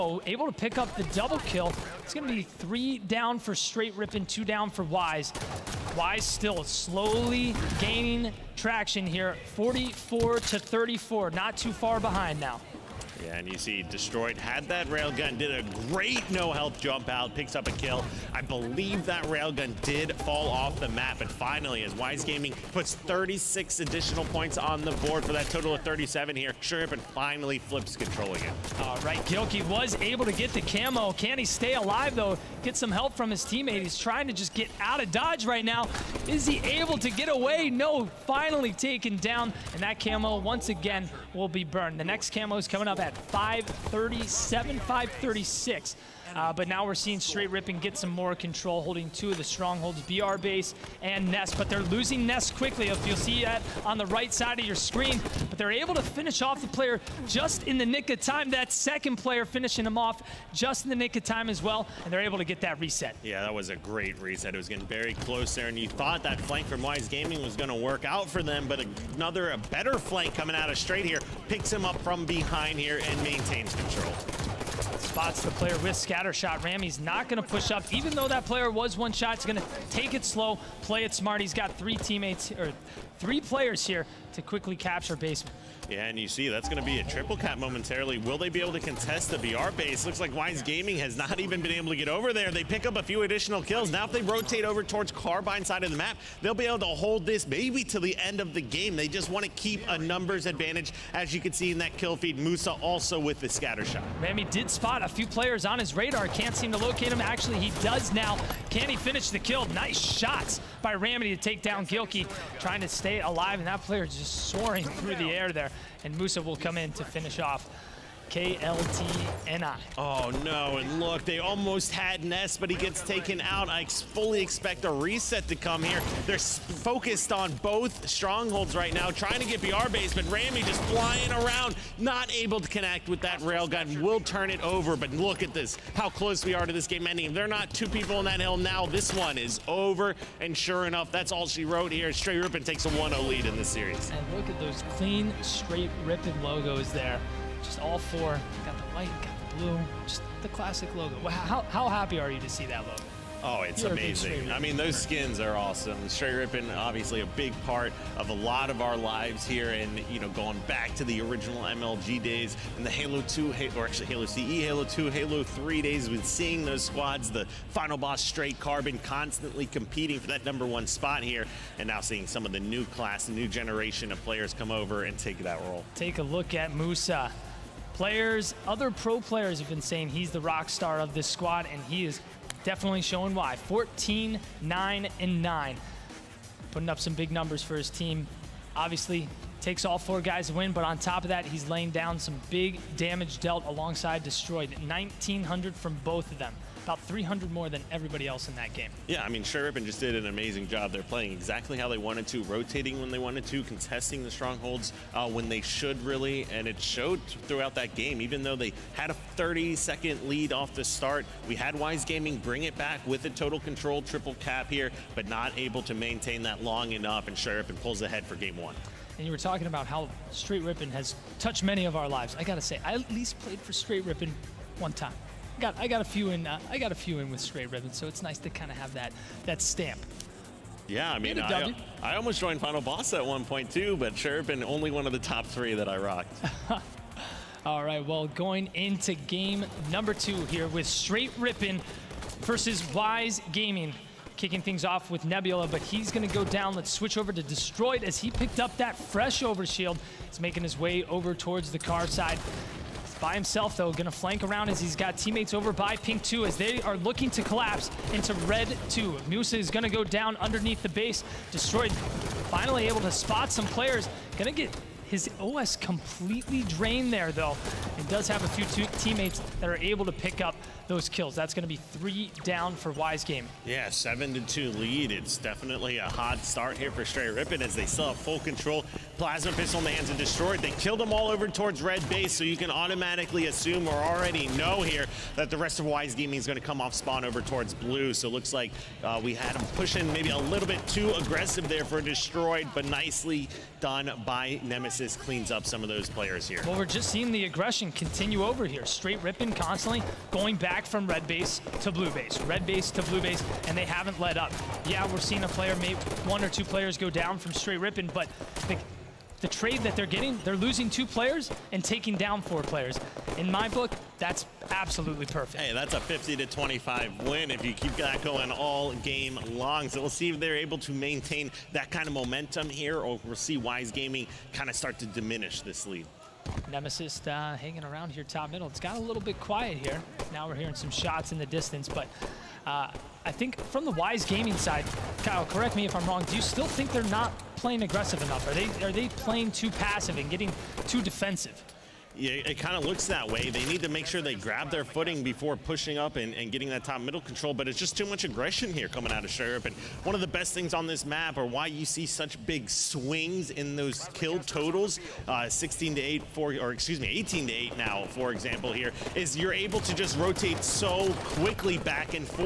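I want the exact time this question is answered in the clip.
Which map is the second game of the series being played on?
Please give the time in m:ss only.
4:05.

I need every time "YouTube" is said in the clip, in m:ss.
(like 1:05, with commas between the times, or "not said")
not said.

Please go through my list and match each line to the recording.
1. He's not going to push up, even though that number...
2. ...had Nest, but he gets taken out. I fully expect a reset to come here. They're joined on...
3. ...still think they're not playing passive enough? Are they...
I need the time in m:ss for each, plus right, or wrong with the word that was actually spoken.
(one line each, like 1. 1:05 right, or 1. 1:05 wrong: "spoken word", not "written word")
1. 1:16 wrong: "player", not "number"
2. 2:01 wrong: "focused", not "joined"
3. 5:36 wrong: "aggressive", not "passive".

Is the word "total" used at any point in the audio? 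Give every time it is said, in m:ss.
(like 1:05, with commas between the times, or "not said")
0:25, 3:33, 5:54.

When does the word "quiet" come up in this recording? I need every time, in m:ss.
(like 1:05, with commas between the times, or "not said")
5:29.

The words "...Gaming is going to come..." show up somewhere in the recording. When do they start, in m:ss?
4:46.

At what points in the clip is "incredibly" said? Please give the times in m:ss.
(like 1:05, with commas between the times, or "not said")
not said.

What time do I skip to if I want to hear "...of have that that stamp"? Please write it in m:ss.
3:48.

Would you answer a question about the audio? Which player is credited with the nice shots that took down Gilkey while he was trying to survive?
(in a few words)
Ramity.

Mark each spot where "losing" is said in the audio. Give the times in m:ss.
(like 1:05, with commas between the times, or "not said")
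0:51, 5:10.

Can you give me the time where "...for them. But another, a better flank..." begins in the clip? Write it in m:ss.
1:08.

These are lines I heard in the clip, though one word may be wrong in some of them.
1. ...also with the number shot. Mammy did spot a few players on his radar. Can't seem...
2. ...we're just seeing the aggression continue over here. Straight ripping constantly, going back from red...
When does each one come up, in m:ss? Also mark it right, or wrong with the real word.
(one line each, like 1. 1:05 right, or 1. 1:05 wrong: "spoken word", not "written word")
1. 1:42 wrong: "scatter", not "number"
2. 4:56 right.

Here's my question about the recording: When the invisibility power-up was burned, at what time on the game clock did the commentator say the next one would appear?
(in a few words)
5:37.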